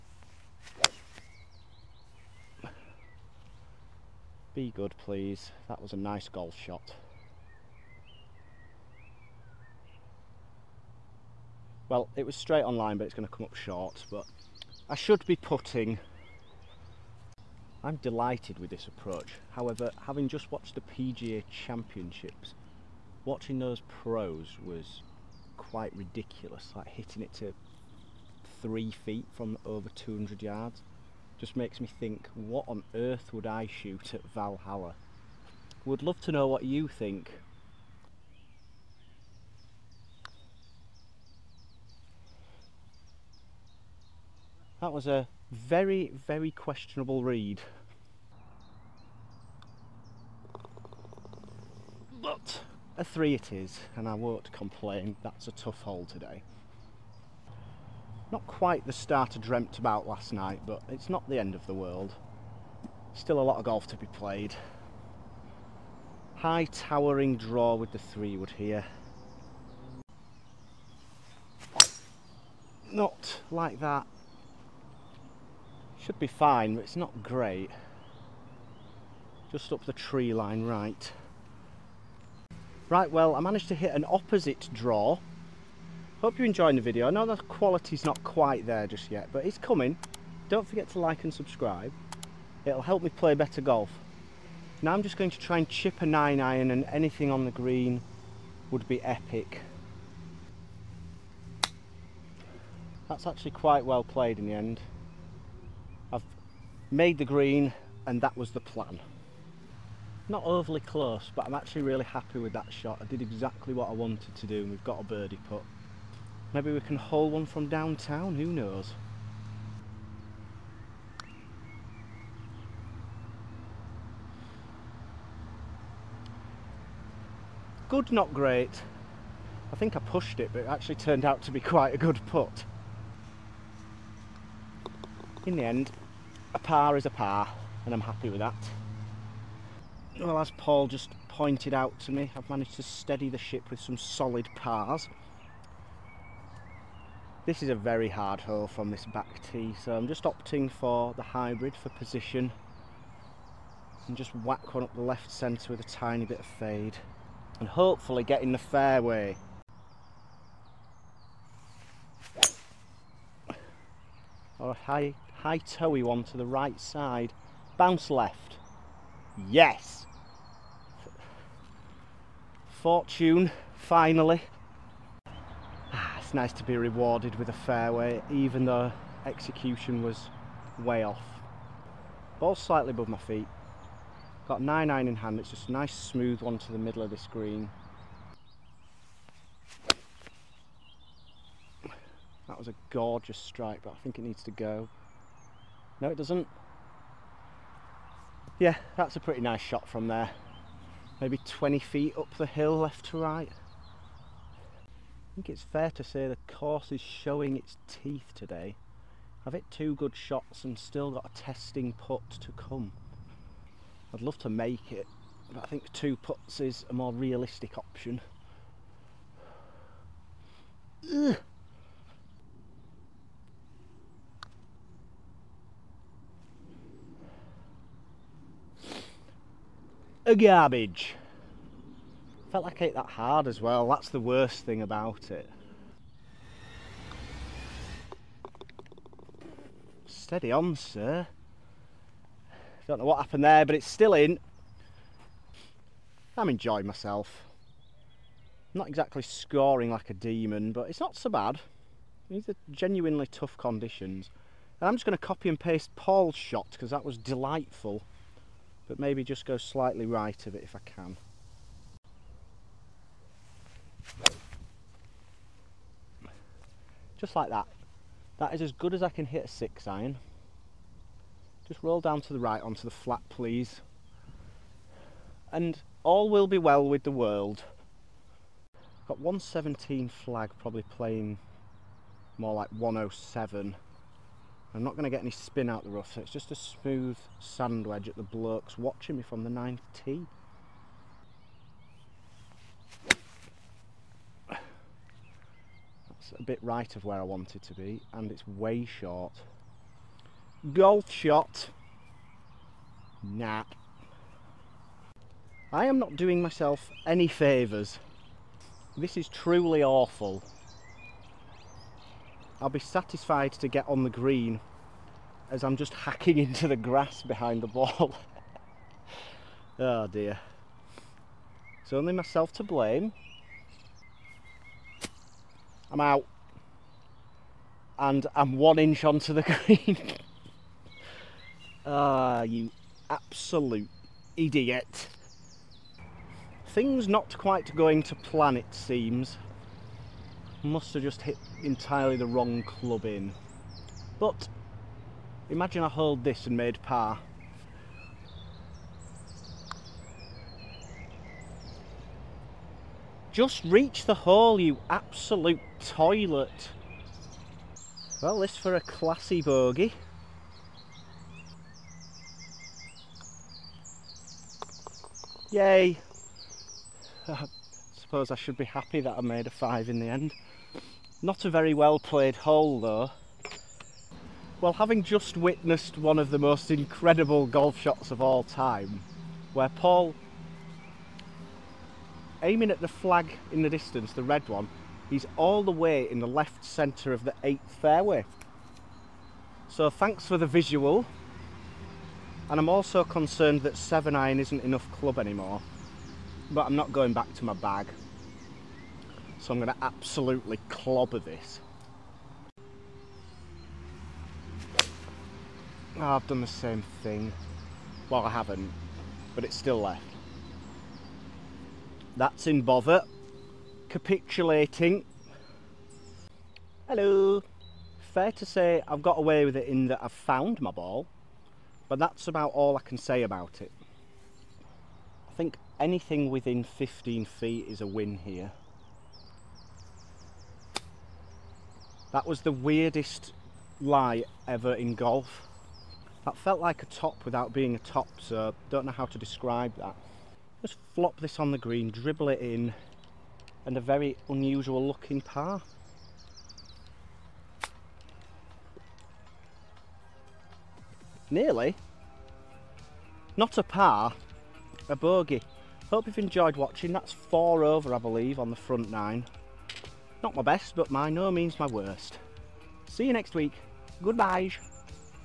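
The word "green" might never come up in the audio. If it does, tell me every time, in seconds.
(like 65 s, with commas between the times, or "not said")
97 s, 107 s, 187 s, 314 s, 329 s, 441 s.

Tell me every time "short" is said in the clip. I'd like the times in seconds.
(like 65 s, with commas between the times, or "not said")
13 s, 298 s.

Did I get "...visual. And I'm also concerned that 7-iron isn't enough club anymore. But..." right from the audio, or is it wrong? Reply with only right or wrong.
right.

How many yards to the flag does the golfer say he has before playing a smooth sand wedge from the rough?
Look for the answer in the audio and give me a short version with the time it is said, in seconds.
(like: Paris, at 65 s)
117, at 279 s.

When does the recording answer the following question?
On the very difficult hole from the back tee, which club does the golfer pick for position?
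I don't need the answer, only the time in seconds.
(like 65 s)
151 s.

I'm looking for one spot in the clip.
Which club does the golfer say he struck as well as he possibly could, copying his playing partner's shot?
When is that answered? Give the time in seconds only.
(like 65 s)
269 s.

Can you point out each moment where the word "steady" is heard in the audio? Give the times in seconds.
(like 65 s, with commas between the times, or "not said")
142 s, 240 s.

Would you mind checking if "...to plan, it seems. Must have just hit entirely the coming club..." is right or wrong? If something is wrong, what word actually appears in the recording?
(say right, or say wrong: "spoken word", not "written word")
wrong: "wrong", not "coming".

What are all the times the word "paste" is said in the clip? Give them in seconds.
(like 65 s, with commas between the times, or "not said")
255 s.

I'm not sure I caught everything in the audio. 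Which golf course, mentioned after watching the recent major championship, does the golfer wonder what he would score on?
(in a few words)
Valhalla.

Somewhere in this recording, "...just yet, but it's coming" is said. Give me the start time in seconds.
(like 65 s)
88 s.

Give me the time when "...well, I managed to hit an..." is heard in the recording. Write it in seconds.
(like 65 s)
83 s.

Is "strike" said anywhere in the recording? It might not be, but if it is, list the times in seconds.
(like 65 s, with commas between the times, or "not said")
193 s.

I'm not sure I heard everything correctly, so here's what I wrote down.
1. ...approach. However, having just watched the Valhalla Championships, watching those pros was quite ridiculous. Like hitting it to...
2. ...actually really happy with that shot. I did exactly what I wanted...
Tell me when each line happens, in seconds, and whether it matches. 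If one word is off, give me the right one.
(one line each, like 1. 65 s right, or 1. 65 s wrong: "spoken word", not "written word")
1. 18 s wrong: "PGA", not "Valhalla"
2. 111 s right.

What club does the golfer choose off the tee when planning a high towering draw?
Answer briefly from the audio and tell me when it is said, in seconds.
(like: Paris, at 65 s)
three wood, at 67 s.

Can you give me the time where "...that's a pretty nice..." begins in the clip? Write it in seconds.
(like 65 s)
198 s.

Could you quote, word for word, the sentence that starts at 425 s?
I think anything within 15 feet is a win here.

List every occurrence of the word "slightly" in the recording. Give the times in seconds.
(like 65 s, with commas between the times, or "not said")
182 s, 259 s.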